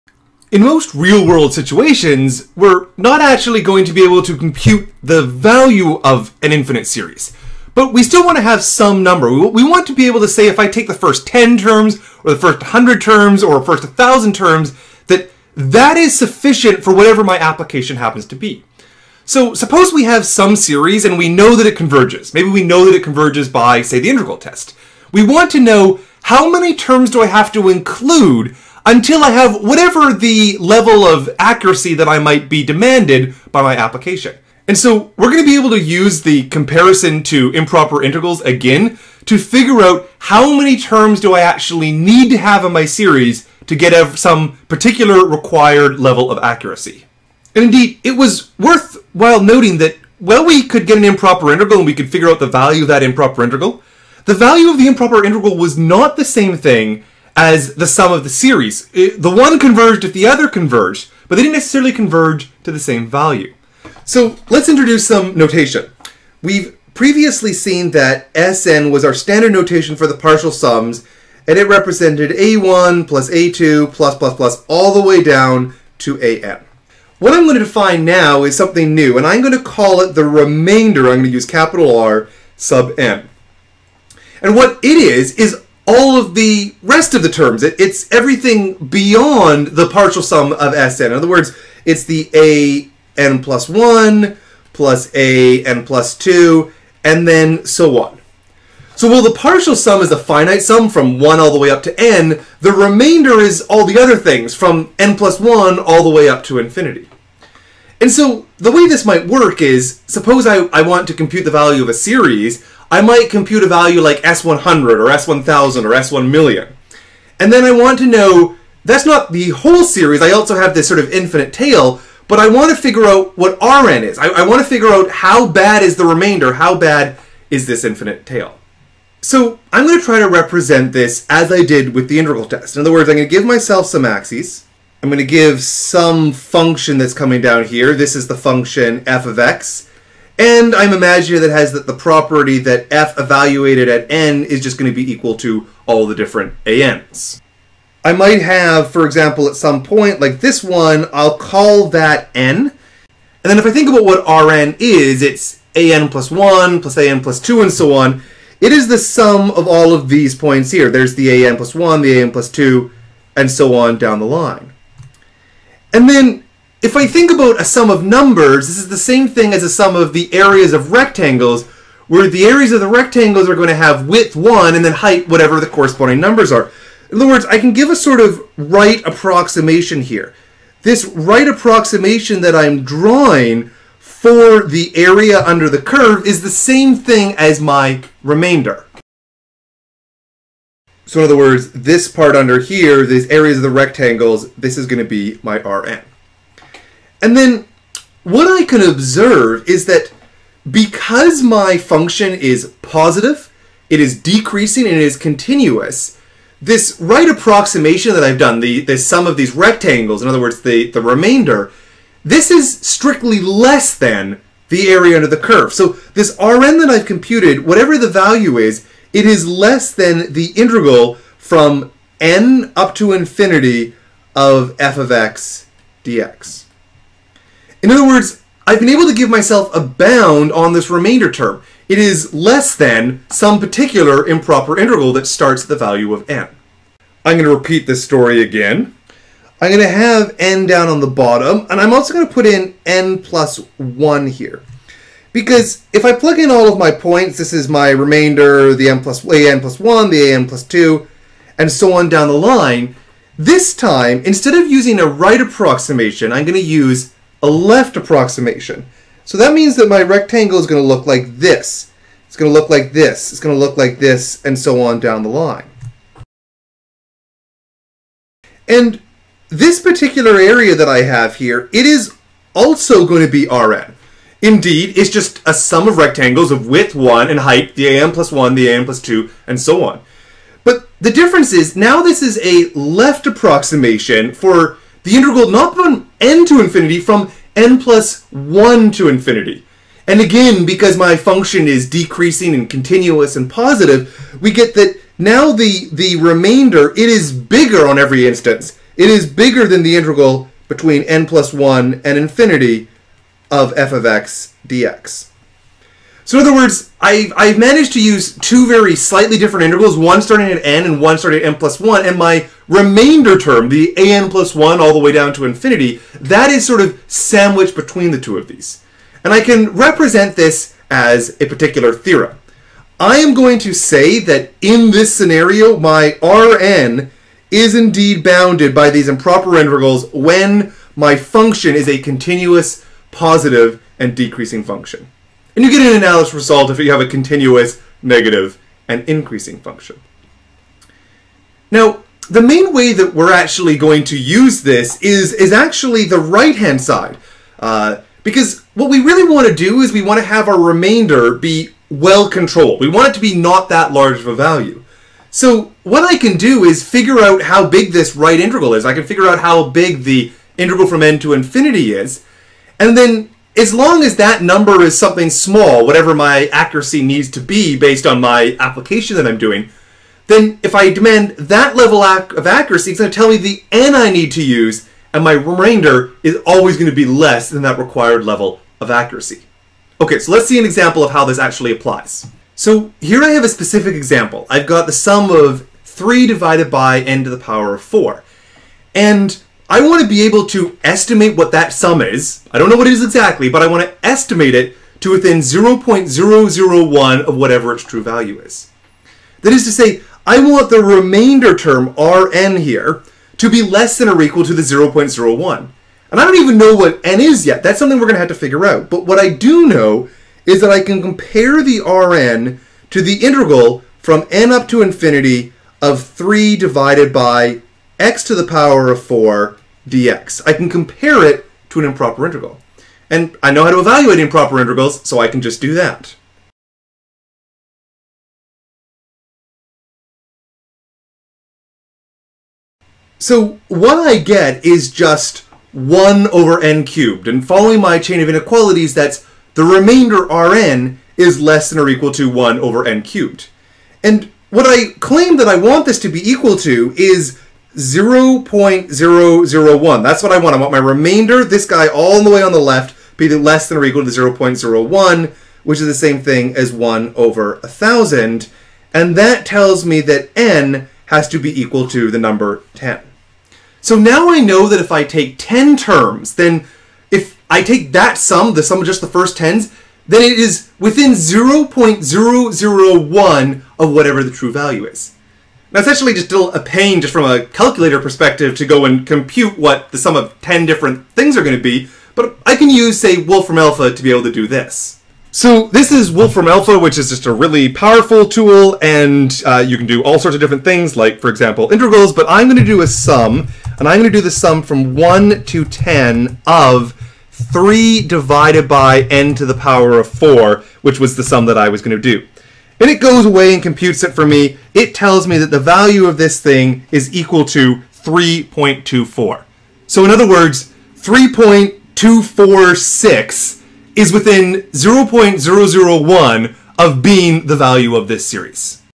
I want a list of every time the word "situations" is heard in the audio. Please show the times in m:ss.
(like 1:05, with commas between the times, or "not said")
0:01.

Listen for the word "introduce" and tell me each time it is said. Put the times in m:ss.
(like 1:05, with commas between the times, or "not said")
1:04.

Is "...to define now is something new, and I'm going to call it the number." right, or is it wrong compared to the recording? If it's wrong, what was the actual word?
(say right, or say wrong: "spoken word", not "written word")
wrong: "remainder", not "number".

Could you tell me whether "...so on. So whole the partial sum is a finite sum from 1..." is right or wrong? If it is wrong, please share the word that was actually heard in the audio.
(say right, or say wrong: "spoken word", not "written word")
wrong: "while", not "whole".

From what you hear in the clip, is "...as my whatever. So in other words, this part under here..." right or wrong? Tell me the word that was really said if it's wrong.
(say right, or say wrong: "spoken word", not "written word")
wrong: "remainder", not "whatever".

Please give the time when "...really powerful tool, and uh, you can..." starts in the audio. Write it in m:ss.
8:07.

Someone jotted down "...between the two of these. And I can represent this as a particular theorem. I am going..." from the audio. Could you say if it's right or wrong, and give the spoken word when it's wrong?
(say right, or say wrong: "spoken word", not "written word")
right.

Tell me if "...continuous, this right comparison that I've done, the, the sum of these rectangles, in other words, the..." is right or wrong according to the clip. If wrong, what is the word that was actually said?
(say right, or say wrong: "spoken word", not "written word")
wrong: "approximation", not "comparison".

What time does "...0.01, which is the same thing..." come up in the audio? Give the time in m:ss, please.
7:34.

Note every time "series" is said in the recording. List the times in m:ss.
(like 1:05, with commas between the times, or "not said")
0:06, 0:20, 0:42, 0:58, 1:51, 1:59, 8:38.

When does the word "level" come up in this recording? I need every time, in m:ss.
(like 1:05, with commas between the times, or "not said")
0:30, 0:45, 6:11, 6:18.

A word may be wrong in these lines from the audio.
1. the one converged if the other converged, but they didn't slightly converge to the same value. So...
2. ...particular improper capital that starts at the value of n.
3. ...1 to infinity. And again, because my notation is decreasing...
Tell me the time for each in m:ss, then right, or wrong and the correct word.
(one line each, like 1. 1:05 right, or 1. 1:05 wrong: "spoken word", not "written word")
1. 0:58 wrong: "necessarily", not "slightly"
2. 3:53 wrong: "integral", not "capital"
3. 4:48 wrong: "function", not "notation".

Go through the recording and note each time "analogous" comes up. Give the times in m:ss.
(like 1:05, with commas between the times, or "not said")
5:35.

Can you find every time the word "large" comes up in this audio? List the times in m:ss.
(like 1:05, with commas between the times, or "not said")
5:53.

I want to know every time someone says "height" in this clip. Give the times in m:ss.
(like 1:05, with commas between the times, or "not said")
2:54, 4:37.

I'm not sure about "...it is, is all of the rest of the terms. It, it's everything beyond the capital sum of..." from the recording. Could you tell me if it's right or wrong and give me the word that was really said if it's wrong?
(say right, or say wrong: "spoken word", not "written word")
wrong: "partial", not "capital".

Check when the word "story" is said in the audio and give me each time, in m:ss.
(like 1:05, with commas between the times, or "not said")
3:58.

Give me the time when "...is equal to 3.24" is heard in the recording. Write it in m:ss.
8:26.